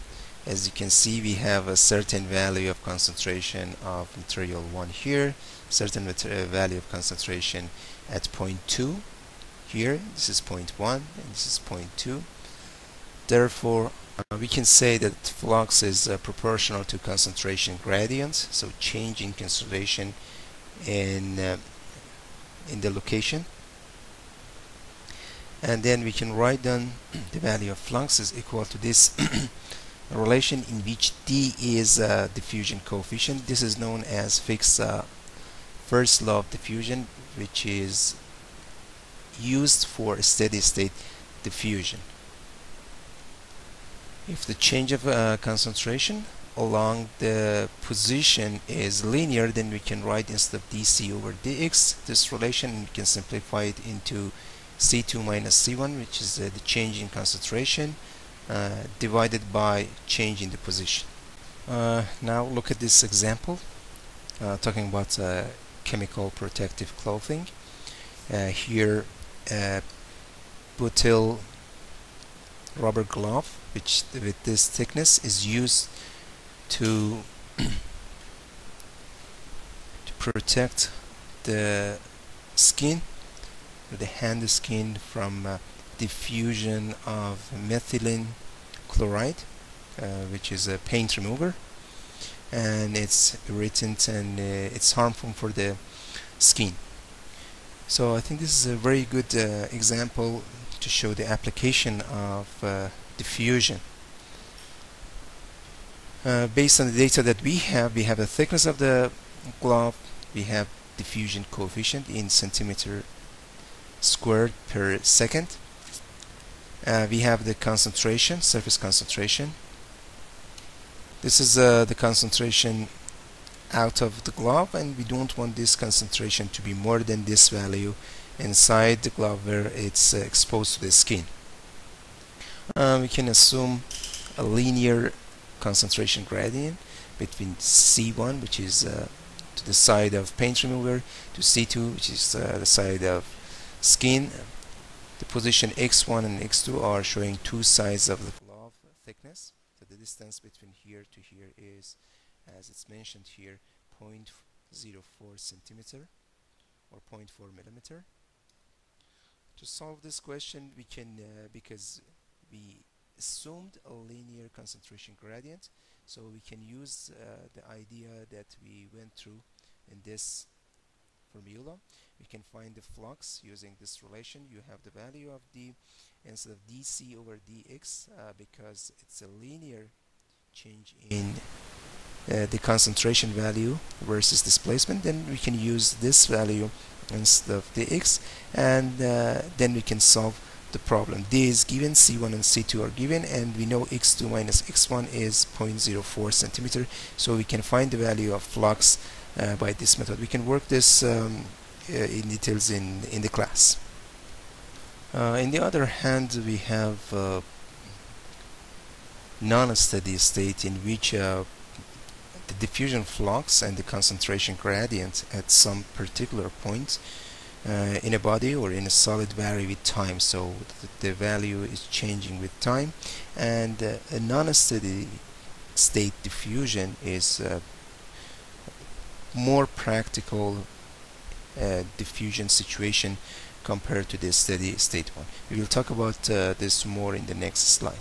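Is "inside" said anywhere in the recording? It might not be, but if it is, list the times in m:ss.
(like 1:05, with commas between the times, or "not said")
2:08.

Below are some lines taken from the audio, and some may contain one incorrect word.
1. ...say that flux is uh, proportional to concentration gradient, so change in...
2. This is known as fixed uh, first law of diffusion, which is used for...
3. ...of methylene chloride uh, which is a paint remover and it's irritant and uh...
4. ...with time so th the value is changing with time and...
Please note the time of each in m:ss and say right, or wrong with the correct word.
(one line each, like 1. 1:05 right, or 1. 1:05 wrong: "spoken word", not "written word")
1. 0:14 right
2. 0:33 right
3. 1:27 right
4. 3:39 right.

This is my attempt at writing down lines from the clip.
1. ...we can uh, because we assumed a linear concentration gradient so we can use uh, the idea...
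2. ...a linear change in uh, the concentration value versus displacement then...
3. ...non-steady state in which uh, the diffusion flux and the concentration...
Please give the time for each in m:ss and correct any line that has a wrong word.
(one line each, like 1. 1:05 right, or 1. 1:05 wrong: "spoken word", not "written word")
1. 2:40 right
2. 2:59 right
3. 3:29 right.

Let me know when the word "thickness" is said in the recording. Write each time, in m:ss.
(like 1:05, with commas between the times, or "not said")
1:14, 1:48, 2:28.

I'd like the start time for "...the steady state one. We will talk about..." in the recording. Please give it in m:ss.
3:54.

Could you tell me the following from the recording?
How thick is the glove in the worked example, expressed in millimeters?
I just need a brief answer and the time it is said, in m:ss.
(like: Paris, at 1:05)
0.4 millimeter, at 2:36.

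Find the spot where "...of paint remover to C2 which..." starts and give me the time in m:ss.
2:20.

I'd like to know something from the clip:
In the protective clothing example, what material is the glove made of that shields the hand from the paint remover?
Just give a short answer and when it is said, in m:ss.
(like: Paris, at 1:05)
butyl rubber, at 1:10.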